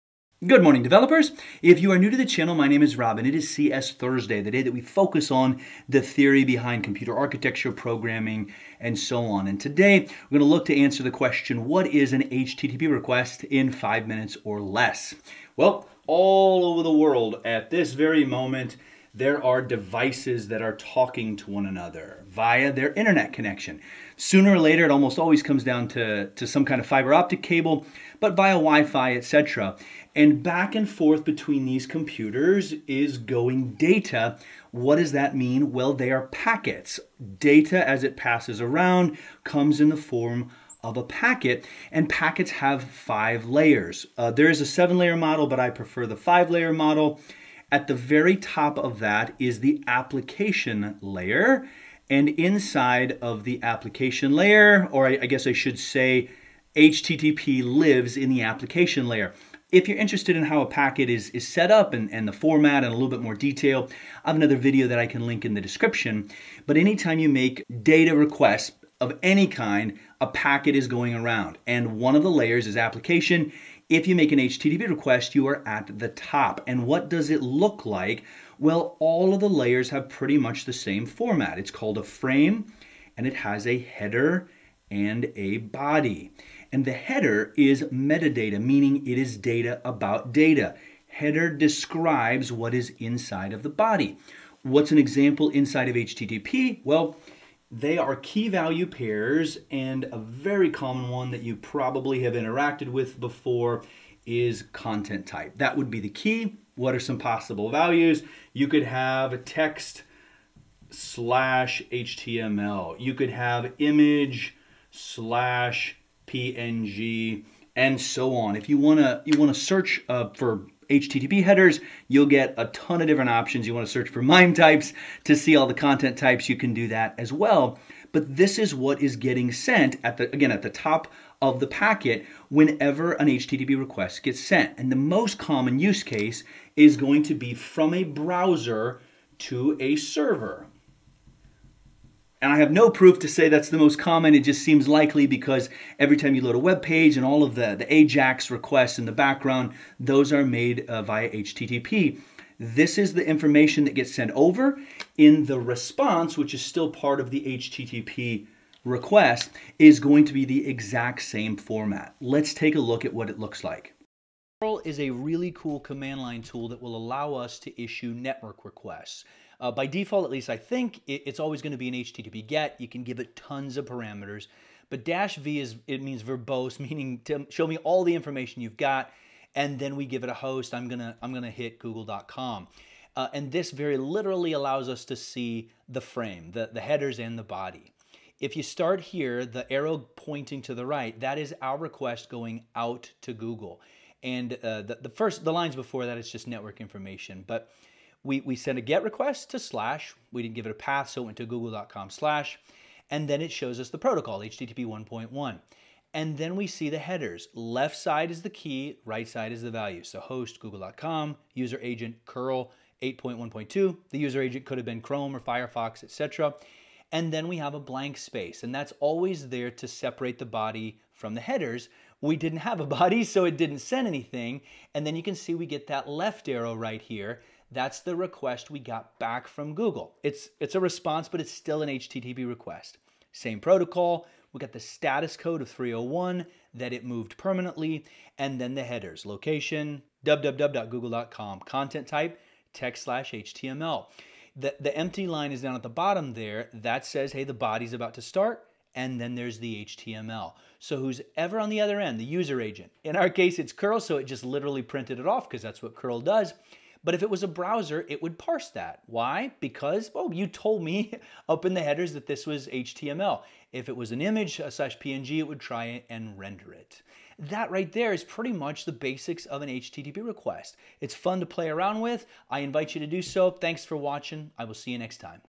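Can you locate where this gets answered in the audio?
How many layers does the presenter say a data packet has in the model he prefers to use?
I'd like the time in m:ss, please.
0:42.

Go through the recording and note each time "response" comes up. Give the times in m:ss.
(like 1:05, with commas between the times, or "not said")
2:35, 3:50.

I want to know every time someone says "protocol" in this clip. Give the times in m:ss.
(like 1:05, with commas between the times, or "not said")
3:23, 3:53.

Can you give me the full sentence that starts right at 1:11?
And one of the layers is application.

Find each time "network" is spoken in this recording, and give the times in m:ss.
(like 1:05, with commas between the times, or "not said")
2:48, 3:16.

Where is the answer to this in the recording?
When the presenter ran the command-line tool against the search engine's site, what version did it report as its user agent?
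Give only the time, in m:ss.
3:33.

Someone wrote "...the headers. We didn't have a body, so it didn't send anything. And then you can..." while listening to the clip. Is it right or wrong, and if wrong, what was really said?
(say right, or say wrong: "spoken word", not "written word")
right.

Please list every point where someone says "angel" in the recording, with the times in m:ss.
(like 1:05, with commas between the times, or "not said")
not said.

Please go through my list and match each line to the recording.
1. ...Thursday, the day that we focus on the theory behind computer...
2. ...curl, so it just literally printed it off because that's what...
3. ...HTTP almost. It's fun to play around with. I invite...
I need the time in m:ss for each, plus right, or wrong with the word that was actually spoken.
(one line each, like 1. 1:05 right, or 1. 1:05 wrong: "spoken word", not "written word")
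1. 0:03 right
2. 4:13 right
3. 4:29 wrong: "request", not "almost".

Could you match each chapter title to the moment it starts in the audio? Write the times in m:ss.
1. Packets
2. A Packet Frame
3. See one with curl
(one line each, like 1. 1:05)
1. 0:35
2. 1:20
3. 2:44.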